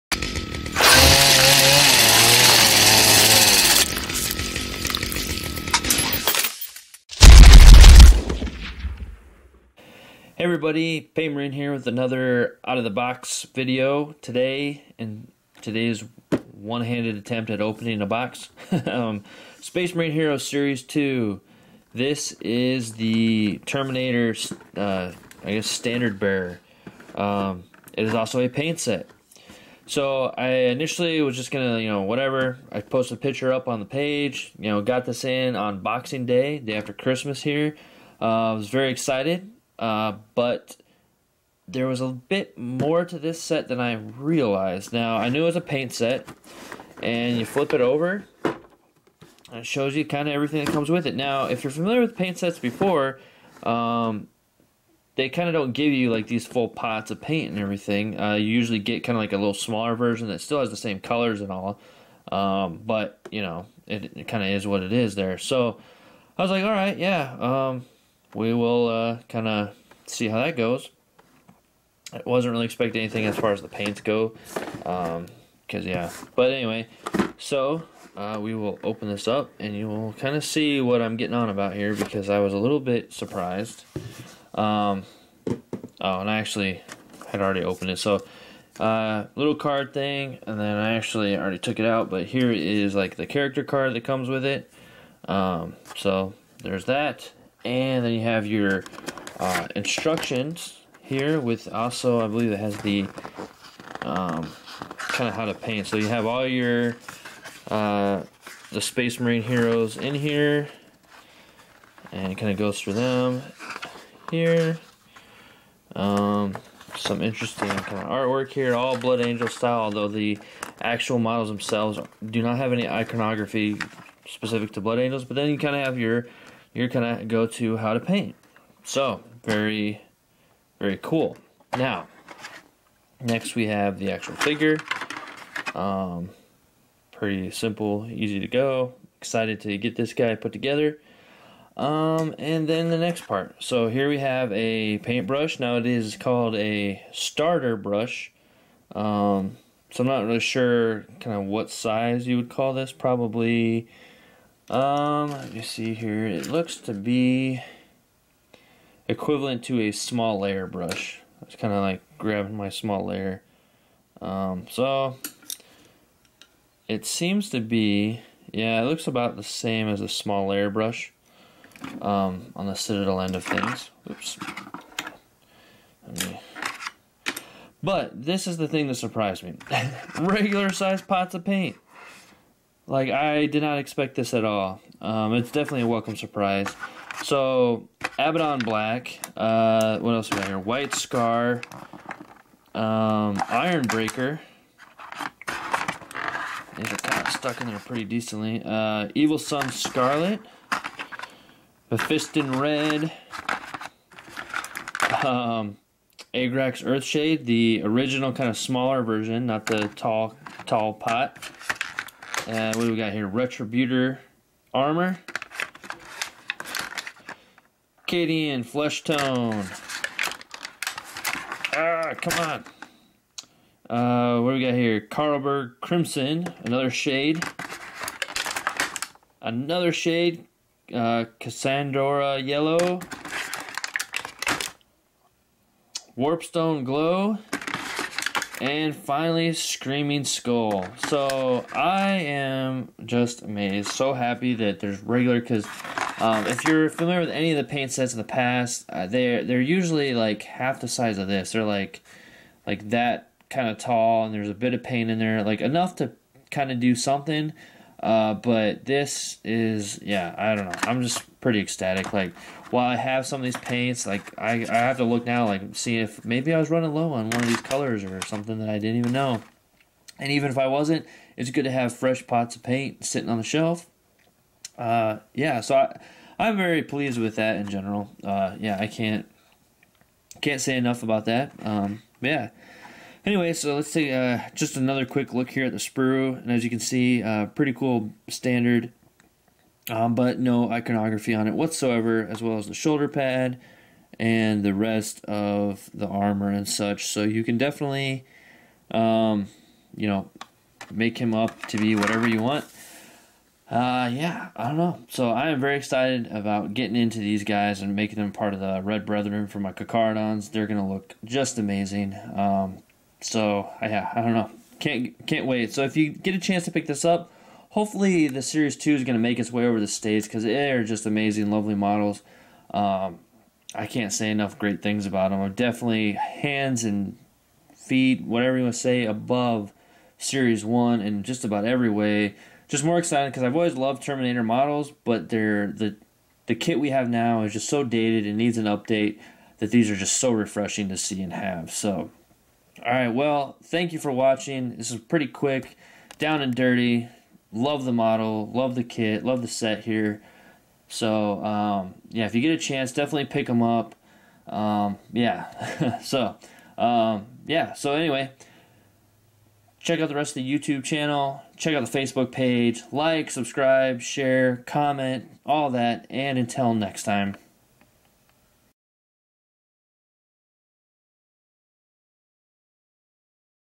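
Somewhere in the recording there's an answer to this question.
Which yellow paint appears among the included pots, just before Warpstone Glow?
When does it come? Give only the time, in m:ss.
3:51.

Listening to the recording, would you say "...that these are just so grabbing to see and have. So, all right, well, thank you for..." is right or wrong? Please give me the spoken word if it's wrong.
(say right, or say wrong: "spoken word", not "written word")
wrong: "refreshing", not "grabbing".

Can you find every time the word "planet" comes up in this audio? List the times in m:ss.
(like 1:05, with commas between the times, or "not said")
not said.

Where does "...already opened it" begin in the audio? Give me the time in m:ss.
1:27.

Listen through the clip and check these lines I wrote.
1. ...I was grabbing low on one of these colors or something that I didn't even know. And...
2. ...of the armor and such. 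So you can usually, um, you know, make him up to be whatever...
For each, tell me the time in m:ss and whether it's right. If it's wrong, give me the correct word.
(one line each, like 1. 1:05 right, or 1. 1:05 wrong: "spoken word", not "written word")
1. 4:26 wrong: "running", not "grabbing"
2. 4:55 wrong: "definitely", not "usually".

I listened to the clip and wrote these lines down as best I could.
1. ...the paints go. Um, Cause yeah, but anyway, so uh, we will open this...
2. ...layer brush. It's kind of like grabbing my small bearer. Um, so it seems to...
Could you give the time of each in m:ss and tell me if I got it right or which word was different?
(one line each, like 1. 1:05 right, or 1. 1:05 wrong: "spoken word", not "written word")
1. 1:13 right
2. 2:40 wrong: "layer", not "bearer".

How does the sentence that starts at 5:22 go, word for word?
Um, I can't say enough great things about them.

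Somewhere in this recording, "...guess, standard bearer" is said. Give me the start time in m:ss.
0:25.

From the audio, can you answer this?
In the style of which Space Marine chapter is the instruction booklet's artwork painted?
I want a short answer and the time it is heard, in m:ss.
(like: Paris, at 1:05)
Blood Angels, at 1:58.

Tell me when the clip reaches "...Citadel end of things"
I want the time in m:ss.
2:52.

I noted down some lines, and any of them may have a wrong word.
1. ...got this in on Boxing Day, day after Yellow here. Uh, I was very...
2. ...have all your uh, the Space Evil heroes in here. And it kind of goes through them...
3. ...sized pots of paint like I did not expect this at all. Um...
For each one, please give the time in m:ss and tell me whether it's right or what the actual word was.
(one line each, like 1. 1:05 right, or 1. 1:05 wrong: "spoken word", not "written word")
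1. 0:34 wrong: "Christmas", not "Yellow"
2. 1:46 wrong: "Marine", not "Evil"
3. 3:00 right.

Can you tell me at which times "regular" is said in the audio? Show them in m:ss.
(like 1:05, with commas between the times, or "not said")
3:00, 4:05.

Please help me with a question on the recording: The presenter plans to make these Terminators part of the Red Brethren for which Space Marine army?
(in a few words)
Carcharodons.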